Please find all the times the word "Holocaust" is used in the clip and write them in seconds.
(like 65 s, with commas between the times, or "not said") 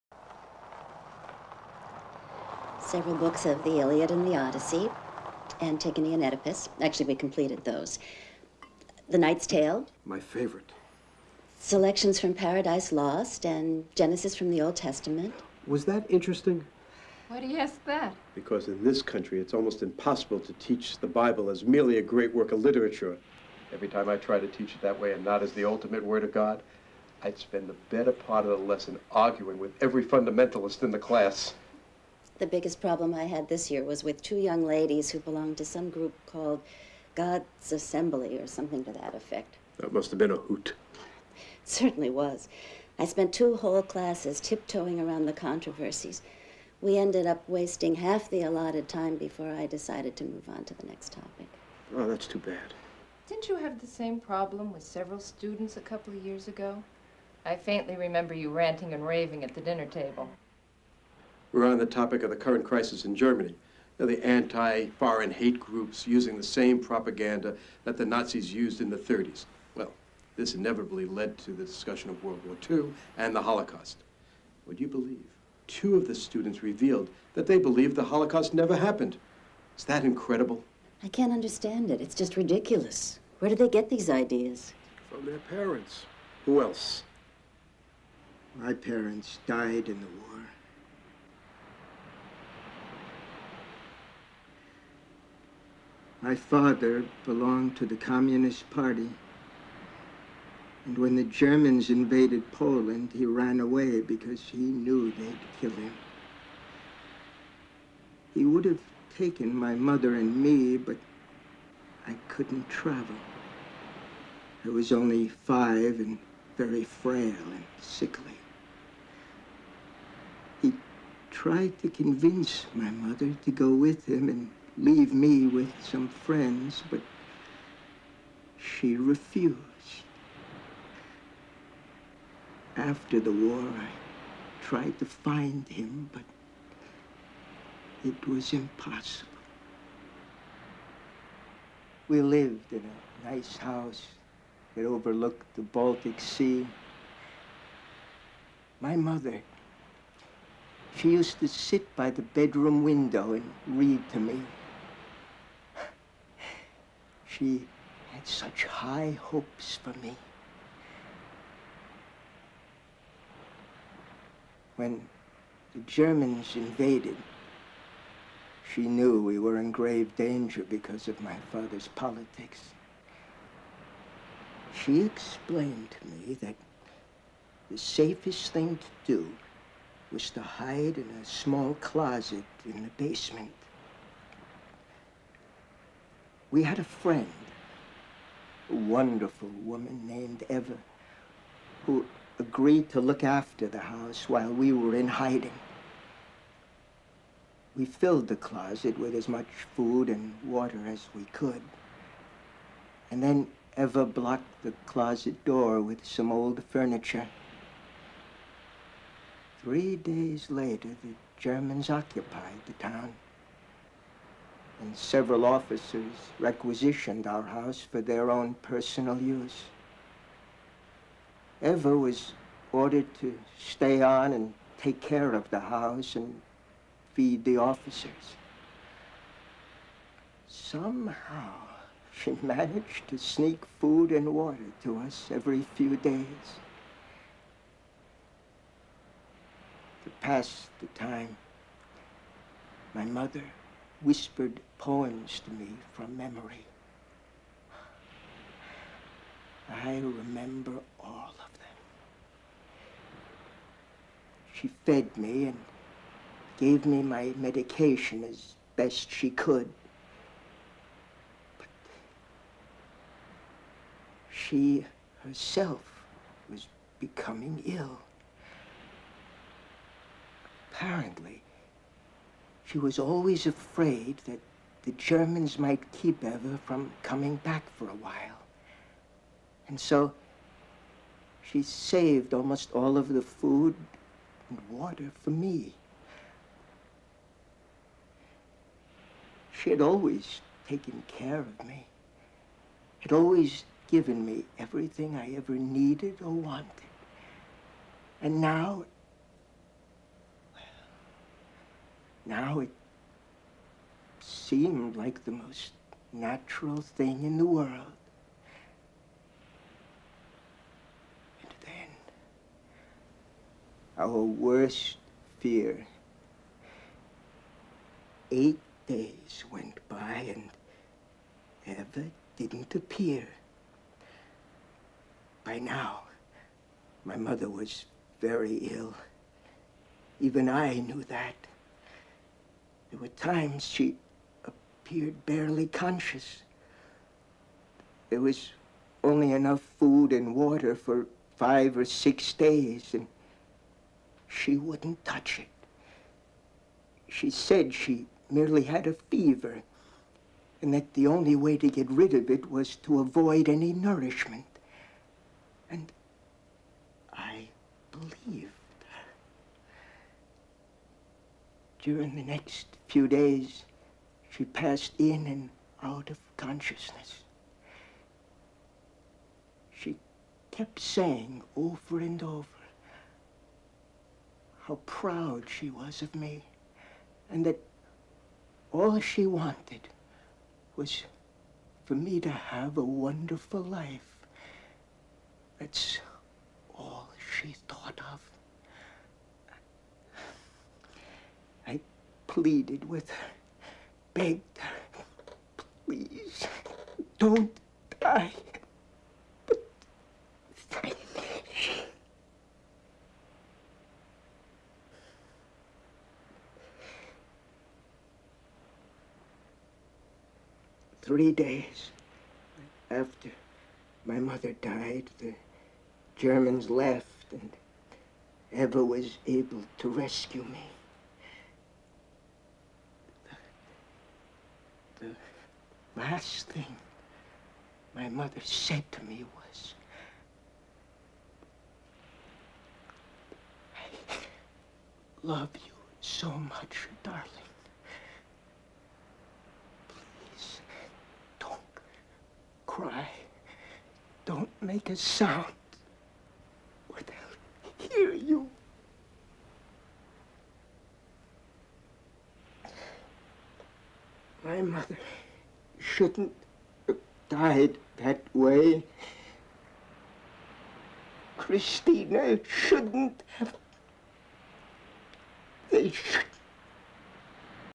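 73 s, 78 s.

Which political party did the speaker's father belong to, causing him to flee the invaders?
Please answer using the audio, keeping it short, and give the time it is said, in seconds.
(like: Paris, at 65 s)
Communist Party, at 97 s.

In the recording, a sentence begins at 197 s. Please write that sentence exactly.
We filled the closet with as much food and water as we could.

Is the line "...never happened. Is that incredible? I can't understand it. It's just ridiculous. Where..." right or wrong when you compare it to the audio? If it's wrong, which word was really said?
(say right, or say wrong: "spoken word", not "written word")
right.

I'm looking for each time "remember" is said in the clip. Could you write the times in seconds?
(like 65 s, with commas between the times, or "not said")
57 s, 249 s.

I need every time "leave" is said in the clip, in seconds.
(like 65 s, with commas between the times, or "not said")
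124 s.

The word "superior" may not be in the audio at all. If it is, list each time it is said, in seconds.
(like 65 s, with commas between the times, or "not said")
not said.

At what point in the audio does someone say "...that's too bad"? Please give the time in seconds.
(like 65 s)
52 s.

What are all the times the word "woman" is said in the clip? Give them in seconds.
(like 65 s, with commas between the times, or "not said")
189 s.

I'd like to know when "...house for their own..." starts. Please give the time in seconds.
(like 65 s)
217 s.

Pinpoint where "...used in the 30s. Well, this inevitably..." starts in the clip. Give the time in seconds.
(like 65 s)
68 s.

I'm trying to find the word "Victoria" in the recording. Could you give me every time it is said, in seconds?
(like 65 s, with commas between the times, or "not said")
not said.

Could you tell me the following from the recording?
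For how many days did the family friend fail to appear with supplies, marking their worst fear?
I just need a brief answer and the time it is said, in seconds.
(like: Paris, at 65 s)
8, at 318 s.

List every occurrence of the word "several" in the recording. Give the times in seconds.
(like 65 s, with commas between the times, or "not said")
2 s, 54 s, 214 s.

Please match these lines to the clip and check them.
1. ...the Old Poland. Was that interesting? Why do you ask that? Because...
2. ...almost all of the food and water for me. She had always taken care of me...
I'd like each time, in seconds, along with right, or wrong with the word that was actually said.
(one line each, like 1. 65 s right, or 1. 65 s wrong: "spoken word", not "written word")
1. 14 s wrong: "Testament", not "Poland"
2. 282 s right.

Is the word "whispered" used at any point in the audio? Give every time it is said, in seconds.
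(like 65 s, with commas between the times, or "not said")
244 s.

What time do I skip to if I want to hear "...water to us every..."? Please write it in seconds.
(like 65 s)
234 s.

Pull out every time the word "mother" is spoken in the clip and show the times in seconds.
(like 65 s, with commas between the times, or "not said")
109 s, 122 s, 148 s, 243 s, 327 s, 414 s, 428 s, 454 s.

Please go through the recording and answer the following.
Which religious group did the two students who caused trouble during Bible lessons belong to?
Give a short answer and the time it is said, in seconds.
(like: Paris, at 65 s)
God's Assembly, at 37 s.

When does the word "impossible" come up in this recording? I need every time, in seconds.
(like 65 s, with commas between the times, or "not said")
19 s, 138 s.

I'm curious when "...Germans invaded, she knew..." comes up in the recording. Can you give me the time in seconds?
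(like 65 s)
165 s.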